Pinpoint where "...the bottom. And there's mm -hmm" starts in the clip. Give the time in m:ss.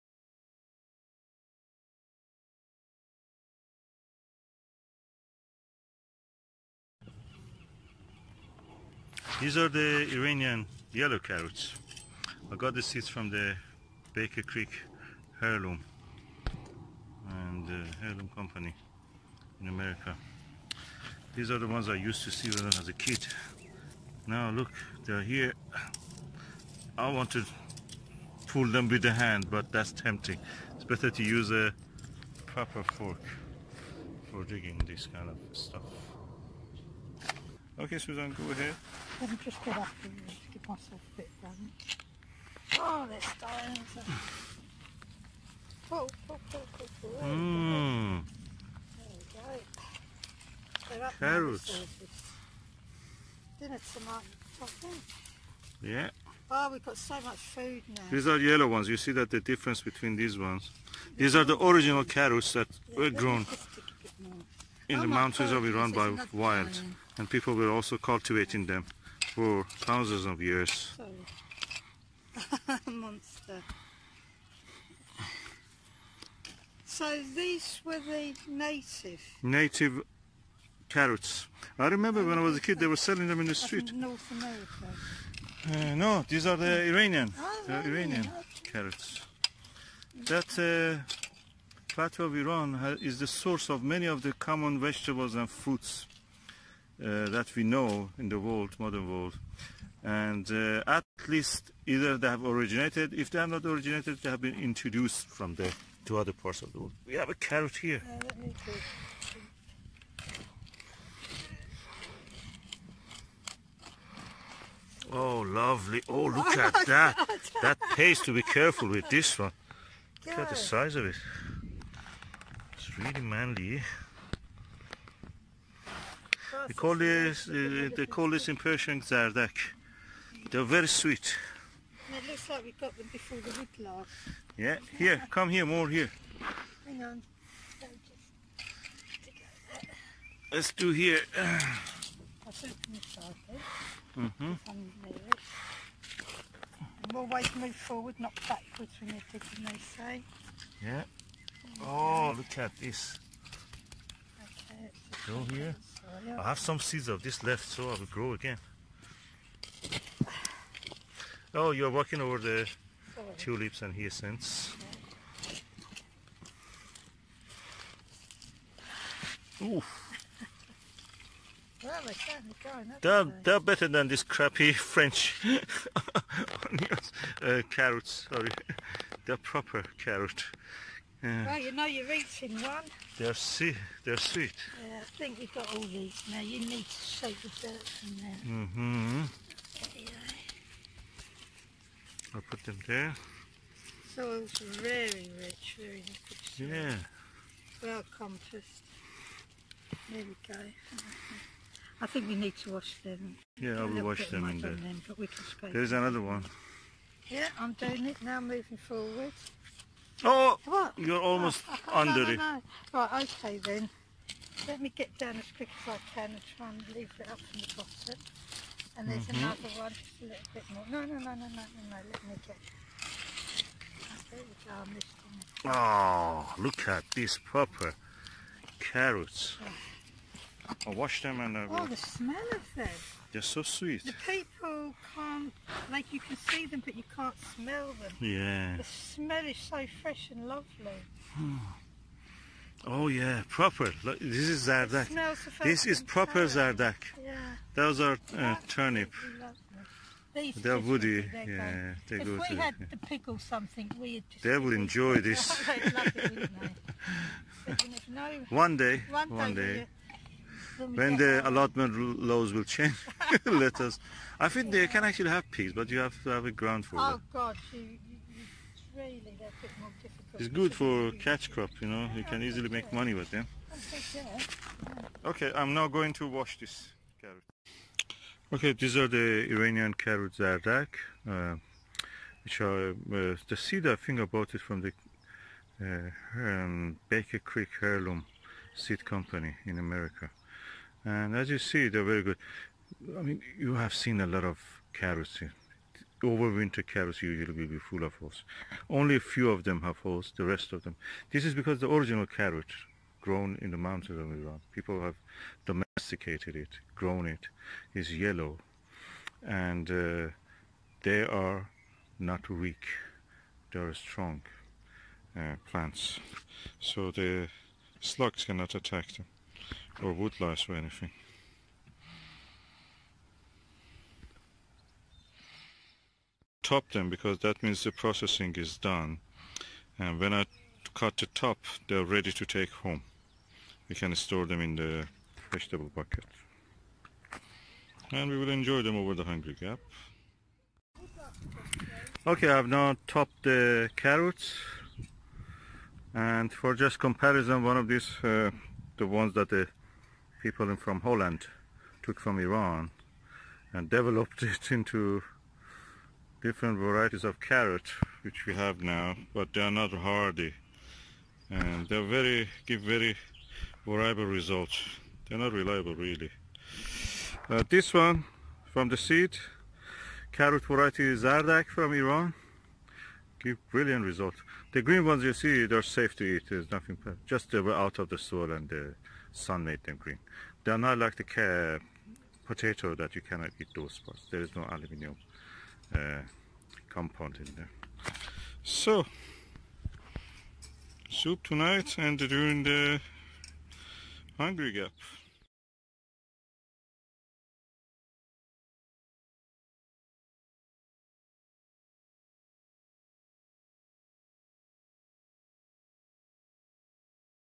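3:37.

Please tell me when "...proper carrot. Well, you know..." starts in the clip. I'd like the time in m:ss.
2:59.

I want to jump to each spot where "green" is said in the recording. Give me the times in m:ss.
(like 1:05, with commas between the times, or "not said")
6:14, 6:19.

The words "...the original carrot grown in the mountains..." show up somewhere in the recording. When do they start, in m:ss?
5:01.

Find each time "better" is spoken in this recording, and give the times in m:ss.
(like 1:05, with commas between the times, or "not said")
0:30, 2:53.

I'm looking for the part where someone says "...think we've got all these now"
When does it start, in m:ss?
3:05.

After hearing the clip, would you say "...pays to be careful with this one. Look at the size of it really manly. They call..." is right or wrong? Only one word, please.
right.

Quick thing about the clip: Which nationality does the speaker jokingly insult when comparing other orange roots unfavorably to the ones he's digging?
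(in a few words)
French.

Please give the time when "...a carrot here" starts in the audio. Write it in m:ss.
1:47.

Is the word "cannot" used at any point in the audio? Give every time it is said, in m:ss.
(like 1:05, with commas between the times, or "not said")
5:18, 6:23.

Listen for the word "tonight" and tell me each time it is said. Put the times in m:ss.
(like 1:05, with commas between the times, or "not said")
0:53, 6:31.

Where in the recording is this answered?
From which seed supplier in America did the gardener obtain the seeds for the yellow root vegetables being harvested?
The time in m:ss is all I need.
4:47.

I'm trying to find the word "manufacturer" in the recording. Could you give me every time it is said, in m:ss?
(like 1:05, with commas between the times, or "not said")
not said.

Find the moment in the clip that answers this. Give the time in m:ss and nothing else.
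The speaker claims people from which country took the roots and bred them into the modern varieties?
5:51.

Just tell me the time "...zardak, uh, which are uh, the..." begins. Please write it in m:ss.
4:40.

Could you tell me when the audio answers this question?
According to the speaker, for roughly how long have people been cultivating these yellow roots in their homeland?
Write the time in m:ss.
1:09.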